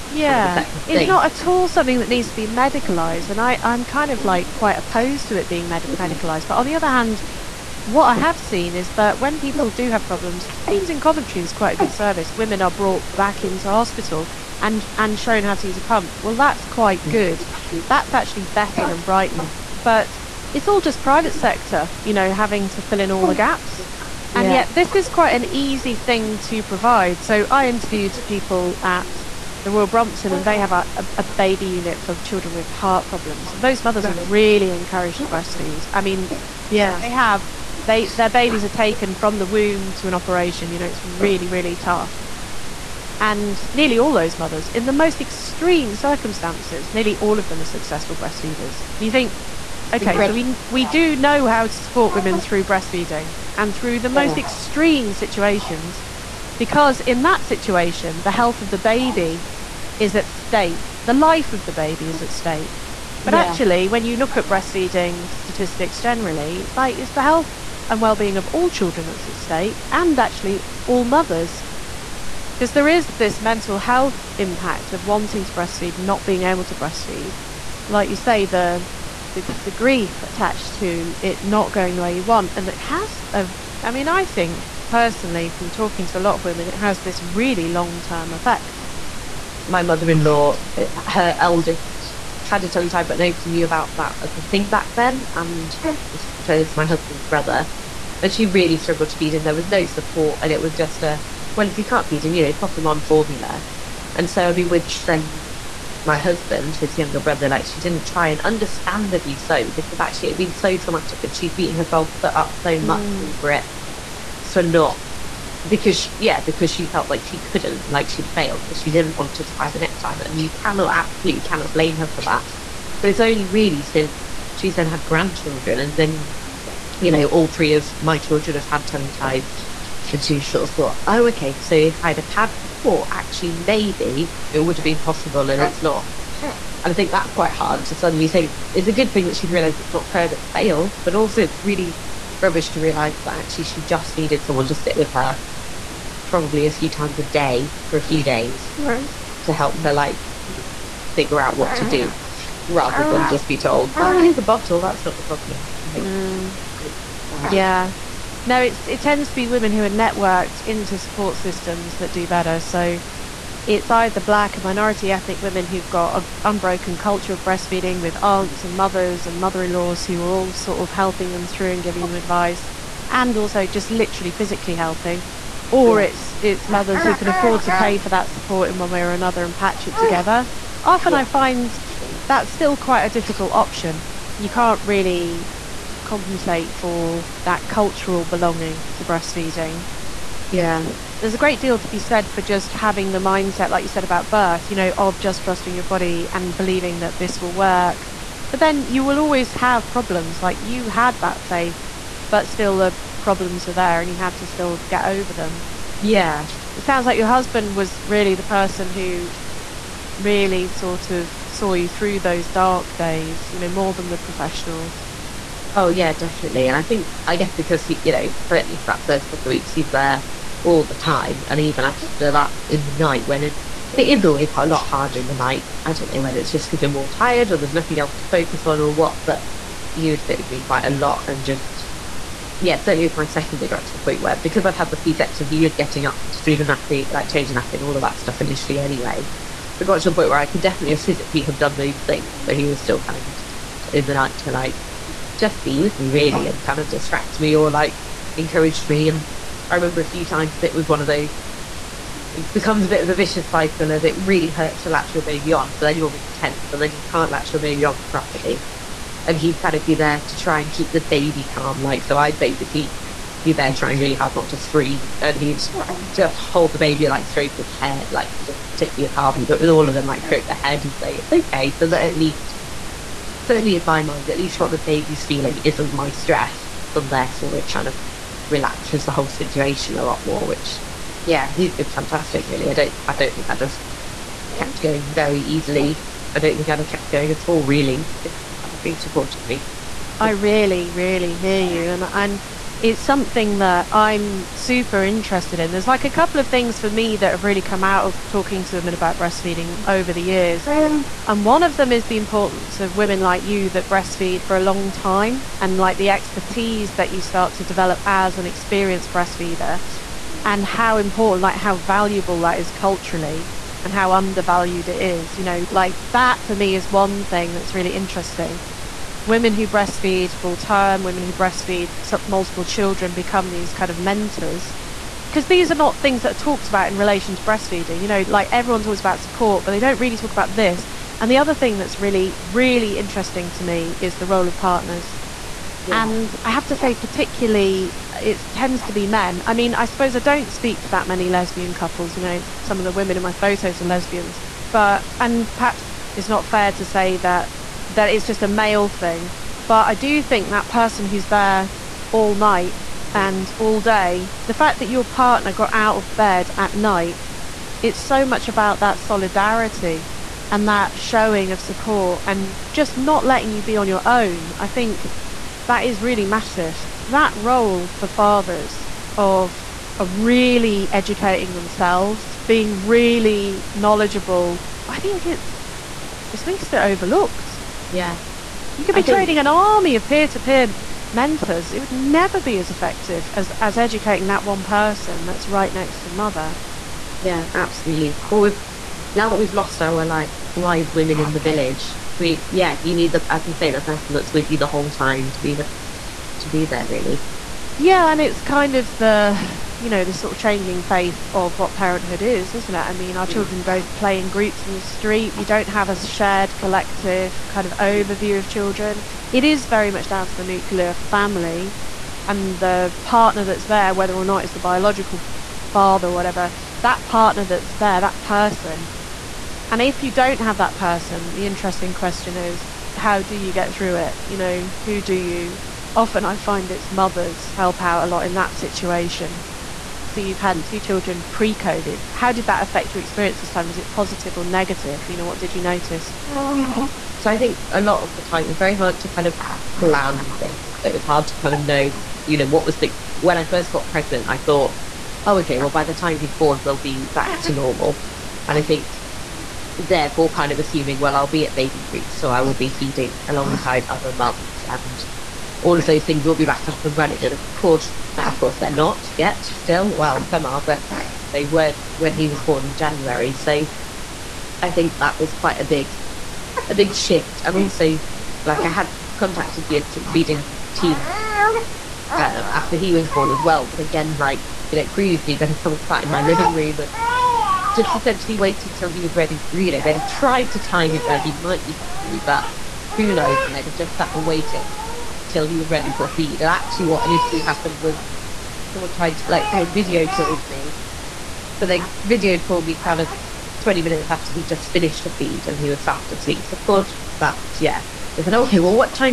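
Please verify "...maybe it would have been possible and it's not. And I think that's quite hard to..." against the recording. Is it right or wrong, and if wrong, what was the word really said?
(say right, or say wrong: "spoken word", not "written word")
right.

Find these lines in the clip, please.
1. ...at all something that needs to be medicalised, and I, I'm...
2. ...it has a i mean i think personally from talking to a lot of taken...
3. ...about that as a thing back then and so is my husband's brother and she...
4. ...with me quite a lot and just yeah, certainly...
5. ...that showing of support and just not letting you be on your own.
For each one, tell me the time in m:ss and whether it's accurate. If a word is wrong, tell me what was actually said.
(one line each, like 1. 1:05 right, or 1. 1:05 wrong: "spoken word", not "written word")
1. 0:01 right
2. 1:22 wrong: "women", not "taken"
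3. 1:33 right
4. 3:50 right
5. 6:00 right.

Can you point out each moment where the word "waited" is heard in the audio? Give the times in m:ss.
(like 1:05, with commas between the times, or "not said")
7:58, 8:04.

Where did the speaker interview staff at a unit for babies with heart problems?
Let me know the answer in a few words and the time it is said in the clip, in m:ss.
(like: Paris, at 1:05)
Royal Brompton, at 0:29.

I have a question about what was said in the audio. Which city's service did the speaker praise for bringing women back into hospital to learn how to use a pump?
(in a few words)
Coventry.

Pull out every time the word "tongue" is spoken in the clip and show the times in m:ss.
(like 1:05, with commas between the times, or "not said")
1:32, 2:08.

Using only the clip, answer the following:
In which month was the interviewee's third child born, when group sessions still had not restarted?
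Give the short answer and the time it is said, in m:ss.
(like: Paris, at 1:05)
January, at 7:42.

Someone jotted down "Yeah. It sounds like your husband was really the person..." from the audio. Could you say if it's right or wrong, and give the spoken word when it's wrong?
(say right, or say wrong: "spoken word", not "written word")
right.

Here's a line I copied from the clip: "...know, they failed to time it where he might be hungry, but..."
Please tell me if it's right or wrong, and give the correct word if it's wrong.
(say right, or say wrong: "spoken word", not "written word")
wrong: "tried", not "failed".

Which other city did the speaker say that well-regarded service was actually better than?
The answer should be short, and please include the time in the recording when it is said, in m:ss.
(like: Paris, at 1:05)
Brighton, at 0:19.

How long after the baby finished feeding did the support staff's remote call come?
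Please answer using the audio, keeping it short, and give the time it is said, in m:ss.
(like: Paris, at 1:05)
20 minutes, at 8:13.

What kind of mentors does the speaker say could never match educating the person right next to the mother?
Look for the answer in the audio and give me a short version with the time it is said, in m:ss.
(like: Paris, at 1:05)
peer to peer mentors, at 6:20.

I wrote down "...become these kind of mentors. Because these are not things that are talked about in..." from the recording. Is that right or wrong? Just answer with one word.
right.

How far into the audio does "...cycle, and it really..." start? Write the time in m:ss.
4:13.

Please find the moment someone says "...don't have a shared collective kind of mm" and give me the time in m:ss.
6:45.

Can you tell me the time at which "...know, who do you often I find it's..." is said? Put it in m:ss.
7:04.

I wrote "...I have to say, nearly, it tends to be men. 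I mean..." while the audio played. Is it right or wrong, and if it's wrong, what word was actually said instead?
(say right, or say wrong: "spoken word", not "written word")
wrong: "particularly", not "nearly".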